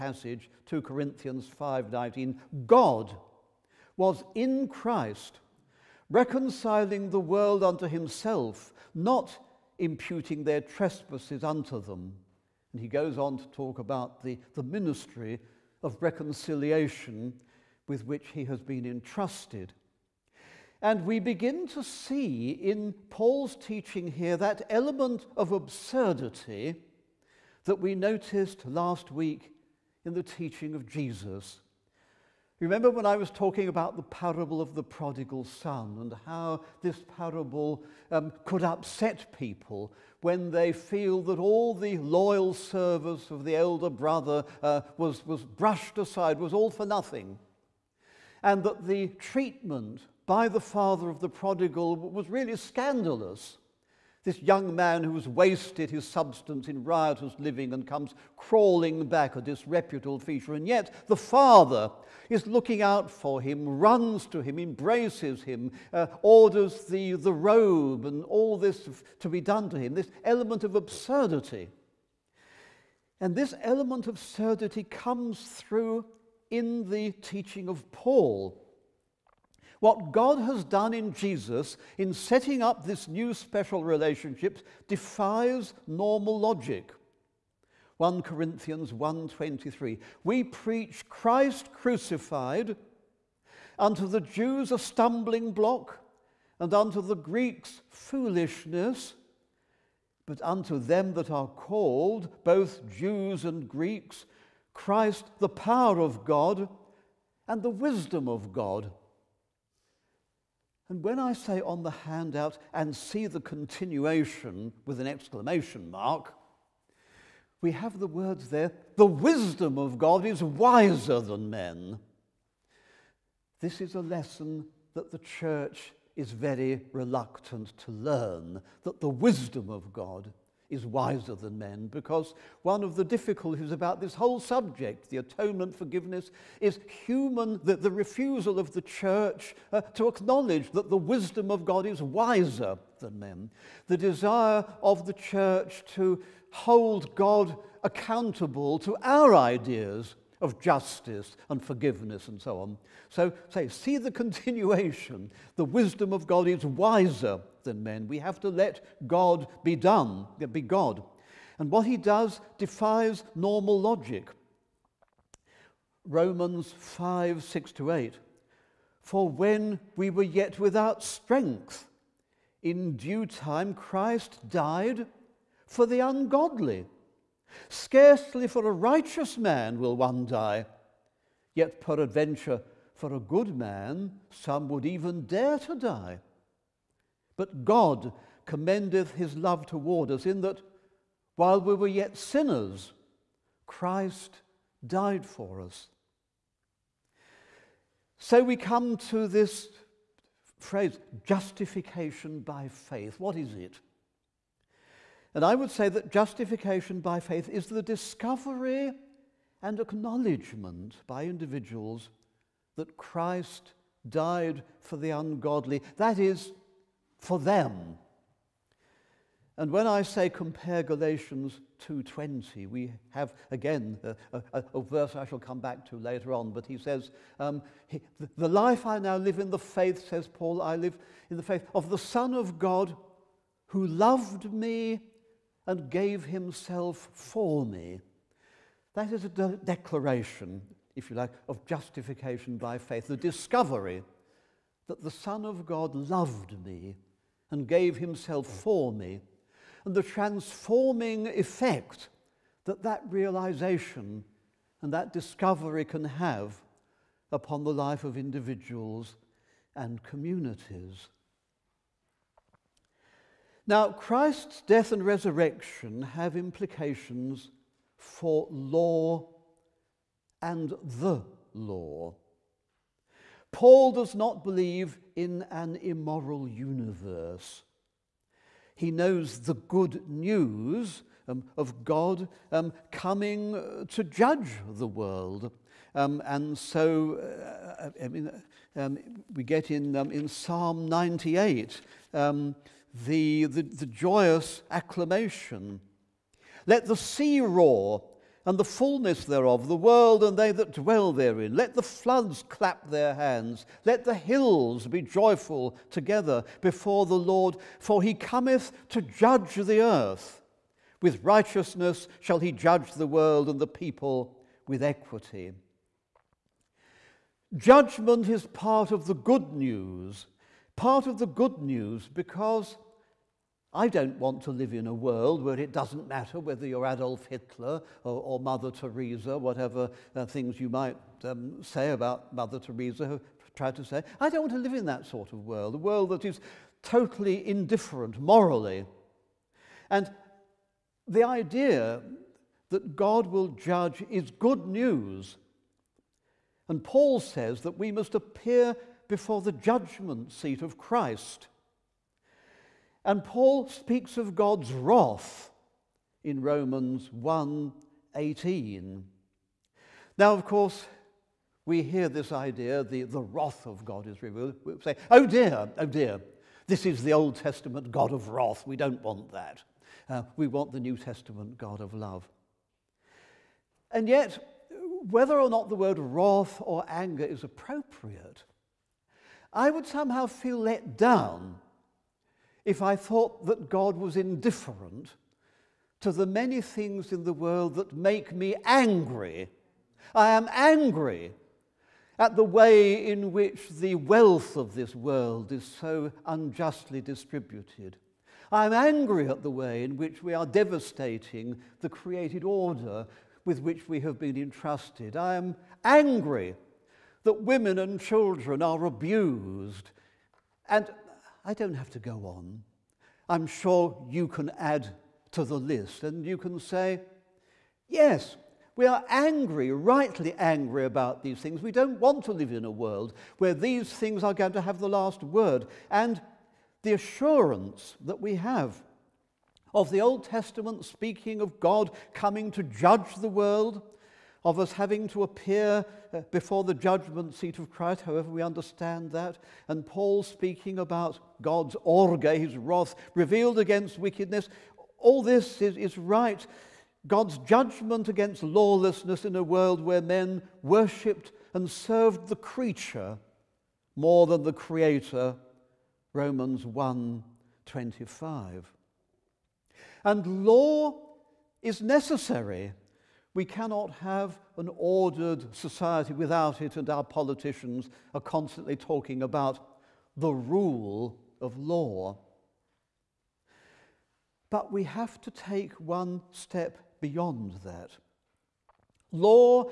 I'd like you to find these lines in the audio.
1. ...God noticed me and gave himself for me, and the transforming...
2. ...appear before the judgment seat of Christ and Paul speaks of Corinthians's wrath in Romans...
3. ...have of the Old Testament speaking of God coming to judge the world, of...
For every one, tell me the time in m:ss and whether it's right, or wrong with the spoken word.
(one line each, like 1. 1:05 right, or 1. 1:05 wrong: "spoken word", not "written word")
1. 4:05 wrong: "loved", not "noticed"
2. 5:48 wrong: "God", not "Corinthians"
3. 7:08 right.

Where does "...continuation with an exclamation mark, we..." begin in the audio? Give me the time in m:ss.
1:53.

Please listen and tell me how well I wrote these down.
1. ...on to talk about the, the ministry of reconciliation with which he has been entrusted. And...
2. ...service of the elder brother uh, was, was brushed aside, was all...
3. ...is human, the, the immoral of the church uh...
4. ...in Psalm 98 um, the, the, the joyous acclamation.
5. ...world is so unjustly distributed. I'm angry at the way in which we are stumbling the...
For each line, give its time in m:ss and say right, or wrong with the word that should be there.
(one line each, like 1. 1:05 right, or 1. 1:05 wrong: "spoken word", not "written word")
1. 0:13 right
2. 0:42 right
3. 2:16 wrong: "refusal", not "immoral"
4. 4:50 right
5. 6:34 wrong: "devastating", not "stumbling".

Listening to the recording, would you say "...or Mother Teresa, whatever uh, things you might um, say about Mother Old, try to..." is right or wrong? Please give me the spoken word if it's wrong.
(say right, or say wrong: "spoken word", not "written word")
wrong: "Teresa", not "Old".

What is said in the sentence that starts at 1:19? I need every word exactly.
What God has done in Jesus in setting up this new special relationship defies normal logic.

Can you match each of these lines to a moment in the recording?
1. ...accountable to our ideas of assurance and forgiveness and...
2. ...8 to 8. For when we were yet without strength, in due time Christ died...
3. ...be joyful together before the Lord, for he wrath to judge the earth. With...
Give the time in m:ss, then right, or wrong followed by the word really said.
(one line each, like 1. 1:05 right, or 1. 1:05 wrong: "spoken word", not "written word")
1. 2:27 wrong: "justice", not "assurance"
2. 2:47 wrong: "6", not "8"
3. 5:04 wrong: "cometh", not "wrath".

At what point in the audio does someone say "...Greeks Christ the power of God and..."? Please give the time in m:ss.
1:43.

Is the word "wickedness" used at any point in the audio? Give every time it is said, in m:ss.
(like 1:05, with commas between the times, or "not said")
7:23.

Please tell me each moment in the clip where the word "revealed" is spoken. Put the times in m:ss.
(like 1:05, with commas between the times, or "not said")
6:04, 7:23.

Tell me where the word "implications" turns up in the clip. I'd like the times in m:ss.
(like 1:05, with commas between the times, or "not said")
4:26.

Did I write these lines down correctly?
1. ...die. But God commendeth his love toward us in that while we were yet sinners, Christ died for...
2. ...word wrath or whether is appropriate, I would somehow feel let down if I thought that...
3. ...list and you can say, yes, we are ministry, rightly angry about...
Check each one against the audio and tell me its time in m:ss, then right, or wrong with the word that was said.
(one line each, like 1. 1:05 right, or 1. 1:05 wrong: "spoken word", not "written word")
1. 3:05 right
2. 6:15 wrong: "anger", not "whether"
3. 6:55 wrong: "angry", not "ministry".